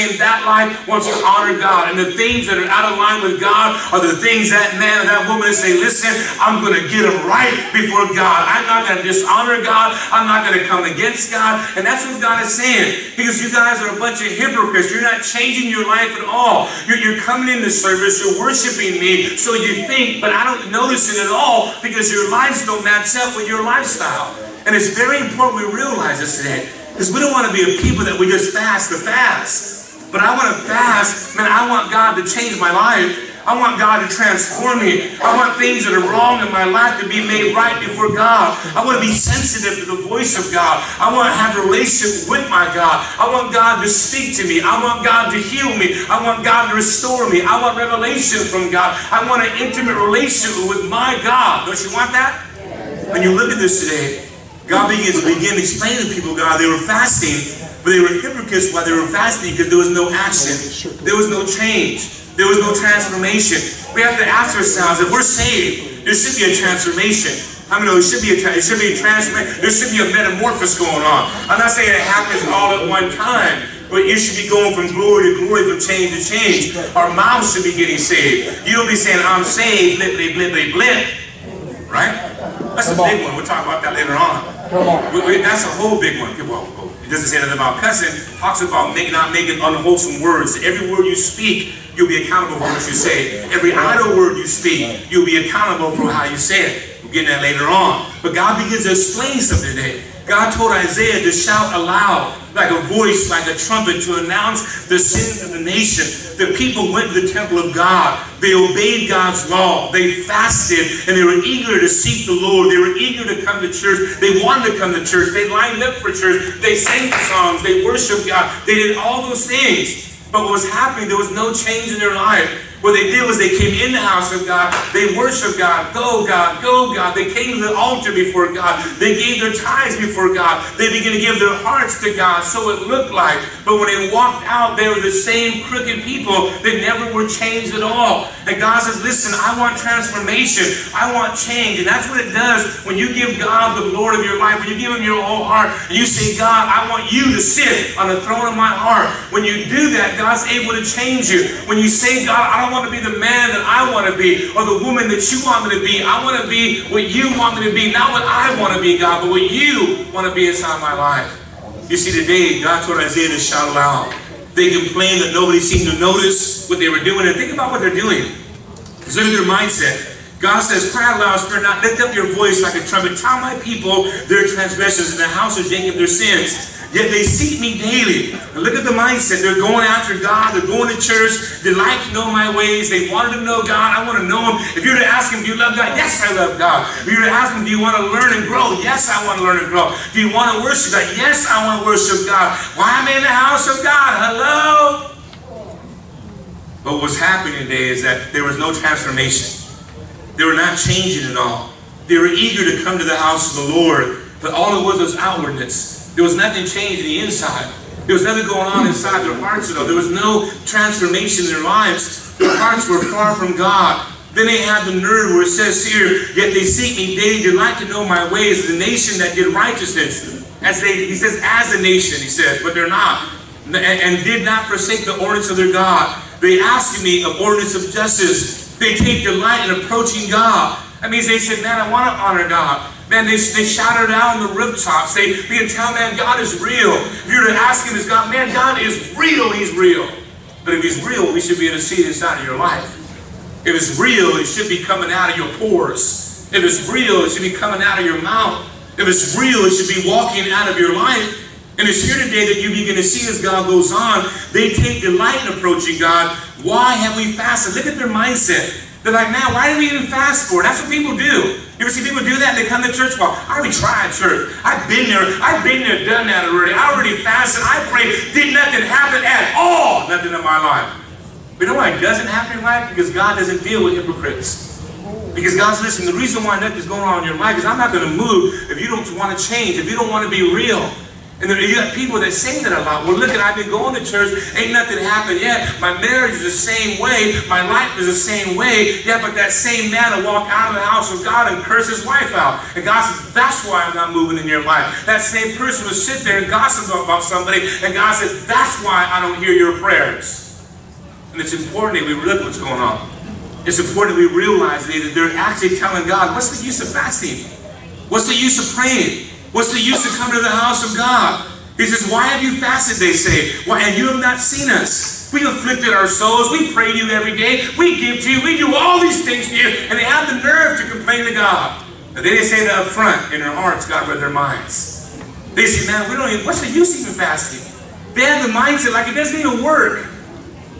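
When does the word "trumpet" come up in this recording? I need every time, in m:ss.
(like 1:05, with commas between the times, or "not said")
1:43, 2:52.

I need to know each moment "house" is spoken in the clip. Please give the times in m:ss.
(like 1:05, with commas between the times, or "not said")
2:04, 2:55, 3:13, 3:23, 4:50, 5:10.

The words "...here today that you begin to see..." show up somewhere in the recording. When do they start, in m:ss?
4:12.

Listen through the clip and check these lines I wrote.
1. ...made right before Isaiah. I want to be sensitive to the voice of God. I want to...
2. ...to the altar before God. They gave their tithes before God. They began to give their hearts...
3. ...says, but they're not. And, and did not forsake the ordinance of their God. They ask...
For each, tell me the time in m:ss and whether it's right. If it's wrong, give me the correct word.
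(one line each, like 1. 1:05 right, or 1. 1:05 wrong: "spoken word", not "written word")
1. 0:37 wrong: "God", not "Isaiah"
2. 2:07 right
3. 3:42 right.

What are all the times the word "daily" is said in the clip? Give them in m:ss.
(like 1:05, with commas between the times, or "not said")
2:57, 3:37.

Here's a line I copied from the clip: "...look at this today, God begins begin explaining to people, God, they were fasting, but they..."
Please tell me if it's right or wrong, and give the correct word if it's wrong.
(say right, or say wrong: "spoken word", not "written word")
right.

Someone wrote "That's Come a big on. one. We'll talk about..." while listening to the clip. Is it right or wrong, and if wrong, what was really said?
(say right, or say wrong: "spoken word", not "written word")
right.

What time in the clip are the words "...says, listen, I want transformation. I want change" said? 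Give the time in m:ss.
2:18.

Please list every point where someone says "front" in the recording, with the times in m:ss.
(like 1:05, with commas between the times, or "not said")
5:22.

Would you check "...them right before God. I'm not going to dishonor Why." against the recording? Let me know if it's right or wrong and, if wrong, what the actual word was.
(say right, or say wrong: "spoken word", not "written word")
wrong: "God", not "Why".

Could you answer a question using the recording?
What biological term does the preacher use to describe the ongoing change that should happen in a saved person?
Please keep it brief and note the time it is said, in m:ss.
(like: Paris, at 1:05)
metamorphosis, at 1:10.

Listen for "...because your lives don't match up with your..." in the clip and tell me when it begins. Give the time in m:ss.
0:21.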